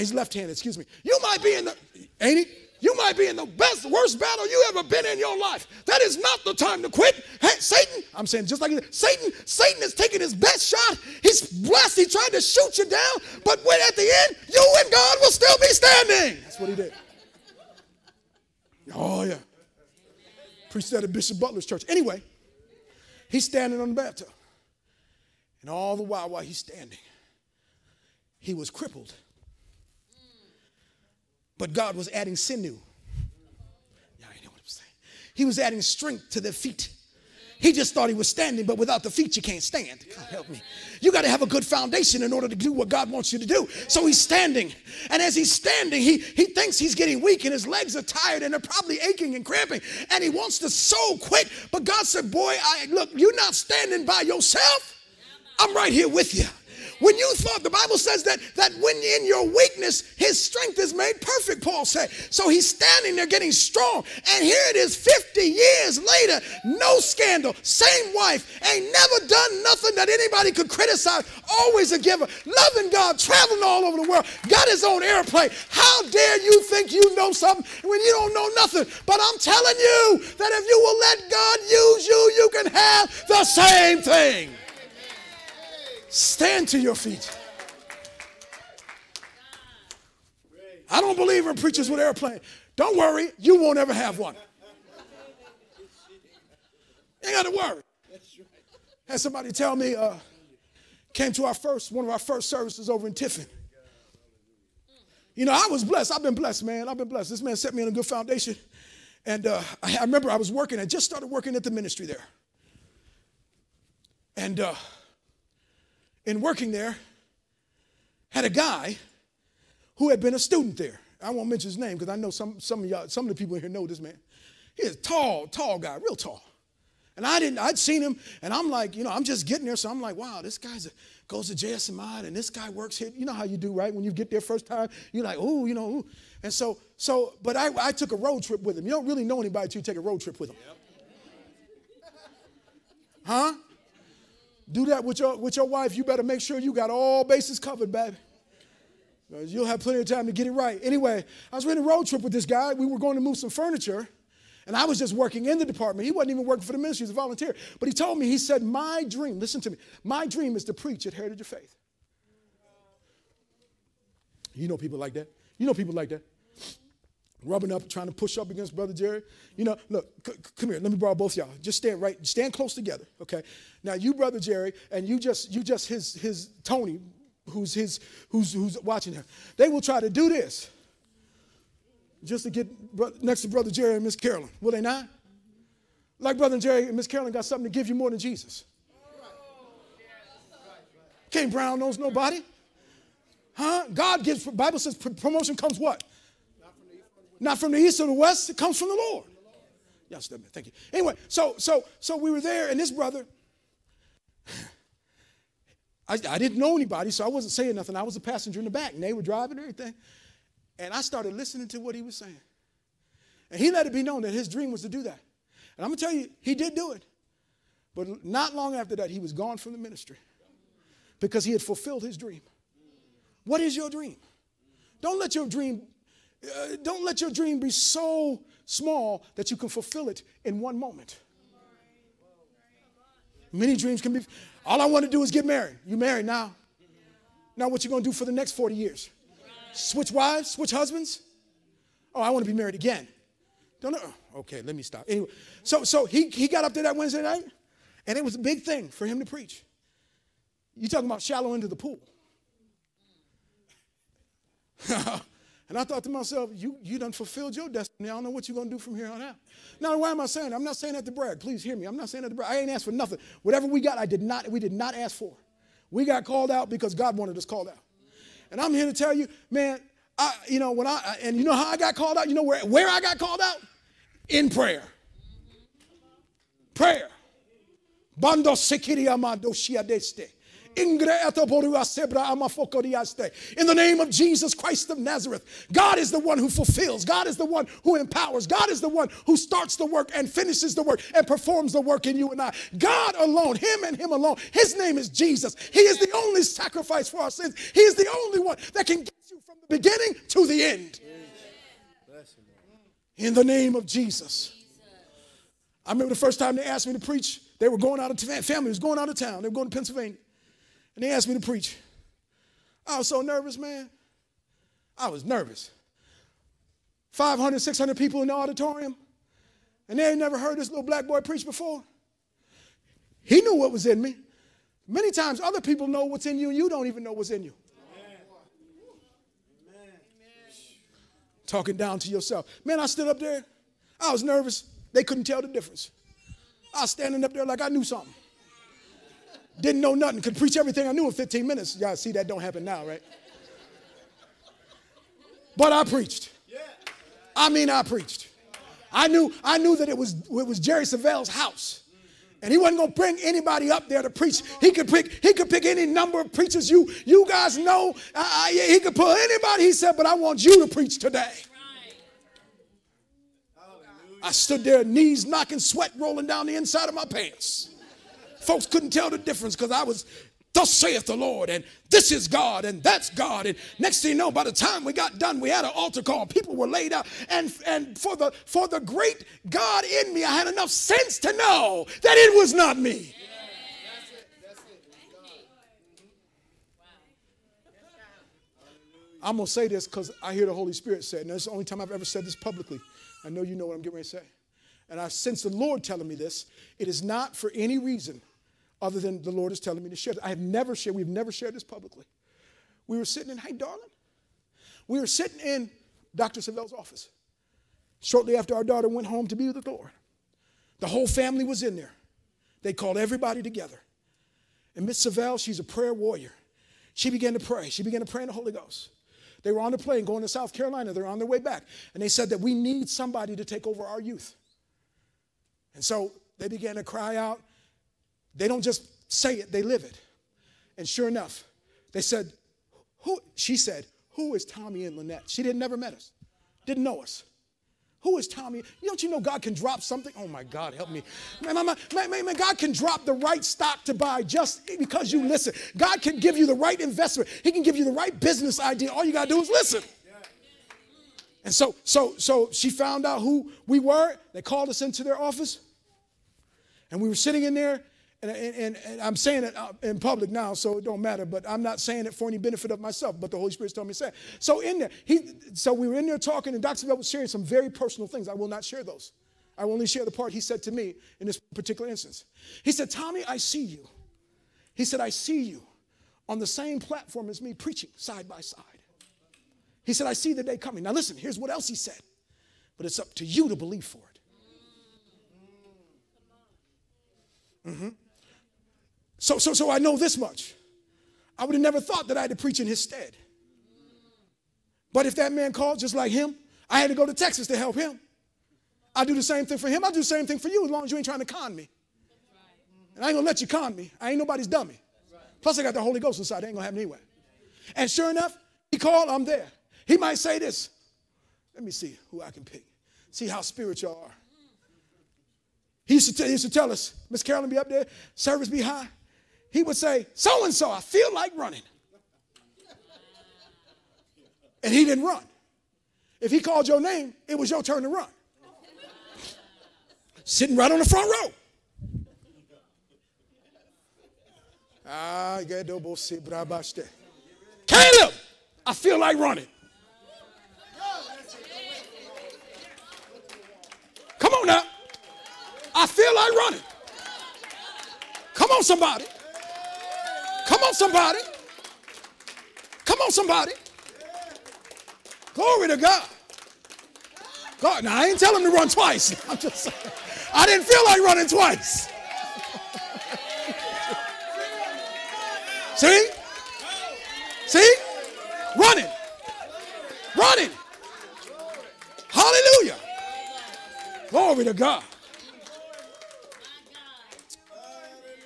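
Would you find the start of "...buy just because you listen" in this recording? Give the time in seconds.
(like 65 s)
443 s.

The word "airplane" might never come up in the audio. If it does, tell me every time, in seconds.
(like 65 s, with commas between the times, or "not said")
75 s, 91 s.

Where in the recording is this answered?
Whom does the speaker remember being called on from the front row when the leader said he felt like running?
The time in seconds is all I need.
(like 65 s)
535 s.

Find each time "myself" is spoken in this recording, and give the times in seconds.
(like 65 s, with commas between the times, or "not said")
256 s, 462 s.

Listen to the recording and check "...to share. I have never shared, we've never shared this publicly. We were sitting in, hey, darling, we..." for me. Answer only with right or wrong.
right.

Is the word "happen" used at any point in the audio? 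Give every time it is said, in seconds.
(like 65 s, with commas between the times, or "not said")
342 s, 506 s.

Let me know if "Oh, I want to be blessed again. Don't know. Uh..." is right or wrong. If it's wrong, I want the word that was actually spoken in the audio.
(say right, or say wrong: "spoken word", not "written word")
wrong: "married", not "blessed".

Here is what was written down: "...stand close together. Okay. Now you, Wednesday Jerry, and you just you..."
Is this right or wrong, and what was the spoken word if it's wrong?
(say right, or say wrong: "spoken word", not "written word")
wrong: "Brother", not "Wednesday".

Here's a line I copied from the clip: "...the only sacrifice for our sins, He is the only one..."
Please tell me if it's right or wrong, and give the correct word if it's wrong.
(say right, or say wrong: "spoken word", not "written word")
right.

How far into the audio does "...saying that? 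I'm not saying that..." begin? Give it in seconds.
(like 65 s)
260 s.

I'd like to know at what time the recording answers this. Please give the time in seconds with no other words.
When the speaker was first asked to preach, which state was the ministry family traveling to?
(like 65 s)
309 s.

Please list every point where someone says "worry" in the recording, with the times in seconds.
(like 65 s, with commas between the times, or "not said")
92 s, 97 s.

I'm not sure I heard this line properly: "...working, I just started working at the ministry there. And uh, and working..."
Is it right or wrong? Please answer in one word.
right.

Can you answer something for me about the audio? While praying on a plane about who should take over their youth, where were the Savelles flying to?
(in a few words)
South Carolina.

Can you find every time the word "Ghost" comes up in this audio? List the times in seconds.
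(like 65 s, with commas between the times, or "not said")
418 s, 505 s.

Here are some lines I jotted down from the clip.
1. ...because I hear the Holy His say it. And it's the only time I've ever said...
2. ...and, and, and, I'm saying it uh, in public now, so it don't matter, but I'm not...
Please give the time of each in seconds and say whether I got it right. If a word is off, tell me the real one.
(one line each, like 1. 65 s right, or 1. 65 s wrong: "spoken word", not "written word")
1. 389 s wrong: "Spirit", not "His"
2. 458 s right.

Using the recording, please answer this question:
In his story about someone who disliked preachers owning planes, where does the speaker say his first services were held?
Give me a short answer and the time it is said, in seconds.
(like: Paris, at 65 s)
Tiffin, at 103 s.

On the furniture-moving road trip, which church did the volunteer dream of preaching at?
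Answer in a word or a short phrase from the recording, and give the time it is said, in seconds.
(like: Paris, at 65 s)
Heritage of Faith, at 161 s.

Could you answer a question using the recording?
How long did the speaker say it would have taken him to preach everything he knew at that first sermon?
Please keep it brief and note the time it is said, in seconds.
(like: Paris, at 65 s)
15 minutes, at 341 s.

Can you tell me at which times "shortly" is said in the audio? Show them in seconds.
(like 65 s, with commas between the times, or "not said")
408 s.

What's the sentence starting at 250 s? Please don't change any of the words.
you talking about shallow into the pool.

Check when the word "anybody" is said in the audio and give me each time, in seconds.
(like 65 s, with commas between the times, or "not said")
70 s, 139 s, 206 s, 353 s, 359 s.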